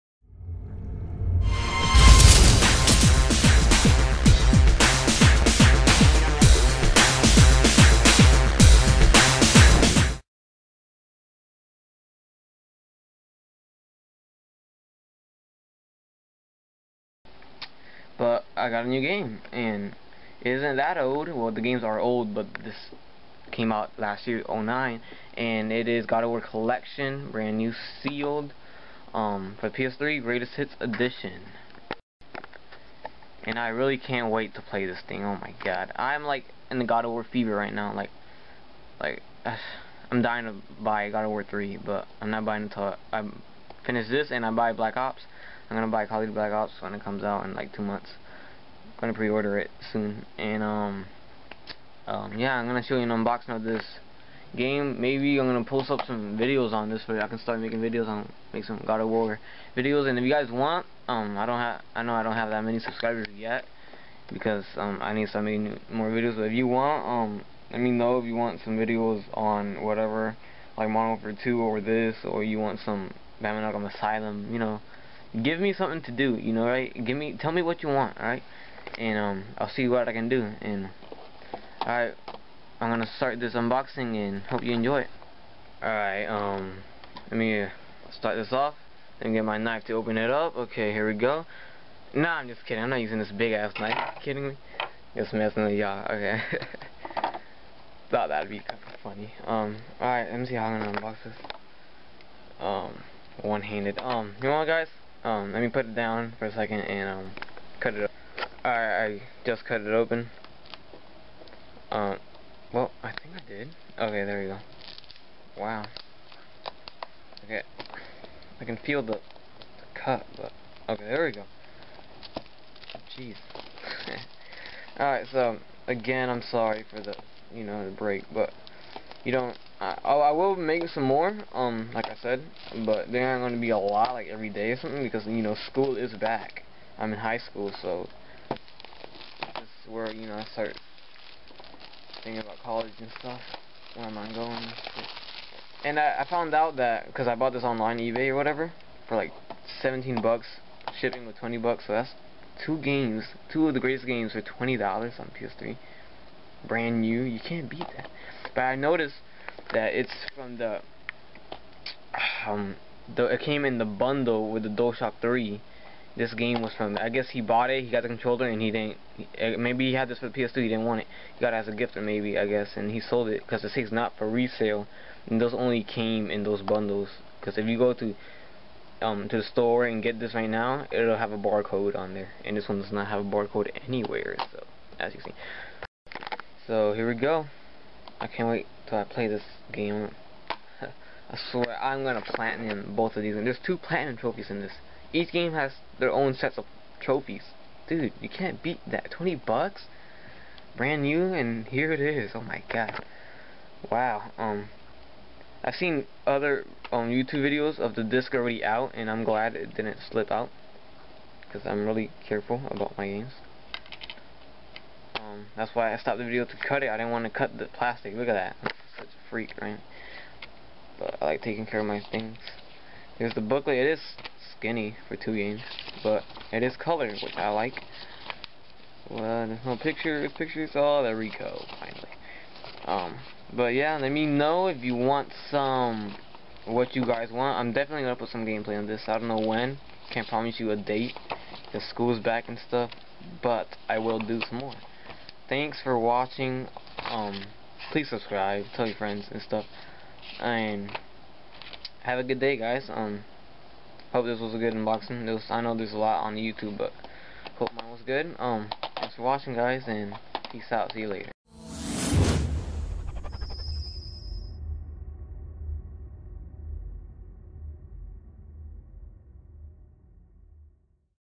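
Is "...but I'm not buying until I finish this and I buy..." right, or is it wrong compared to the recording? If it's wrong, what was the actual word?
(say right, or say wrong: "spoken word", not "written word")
right.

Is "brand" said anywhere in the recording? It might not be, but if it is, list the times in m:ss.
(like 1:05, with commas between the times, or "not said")
0:27, 2:36, 3:20.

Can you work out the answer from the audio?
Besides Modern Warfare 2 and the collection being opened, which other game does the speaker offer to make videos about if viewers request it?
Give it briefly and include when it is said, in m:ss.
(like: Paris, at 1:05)
Batman Arkham Asylum, at 1:13.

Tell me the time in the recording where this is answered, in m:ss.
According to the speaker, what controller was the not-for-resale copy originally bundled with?
2:44.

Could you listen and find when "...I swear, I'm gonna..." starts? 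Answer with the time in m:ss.
3:10.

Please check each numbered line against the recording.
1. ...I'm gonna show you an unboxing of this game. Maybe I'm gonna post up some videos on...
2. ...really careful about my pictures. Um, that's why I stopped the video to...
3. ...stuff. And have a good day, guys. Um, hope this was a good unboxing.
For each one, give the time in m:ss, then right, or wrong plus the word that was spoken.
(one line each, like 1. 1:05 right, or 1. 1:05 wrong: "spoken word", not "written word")
1. 0:52 right
2. 3:31 wrong: "games", not "pictures"
3. 4:09 right.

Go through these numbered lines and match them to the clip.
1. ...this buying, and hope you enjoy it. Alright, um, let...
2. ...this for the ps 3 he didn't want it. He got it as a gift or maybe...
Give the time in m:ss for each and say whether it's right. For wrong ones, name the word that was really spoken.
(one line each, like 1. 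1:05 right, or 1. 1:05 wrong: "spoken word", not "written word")
1. 1:23 wrong: "unboxing", not "buying"
2. 2:50 wrong: "2", not "3".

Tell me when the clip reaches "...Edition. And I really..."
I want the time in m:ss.
0:30.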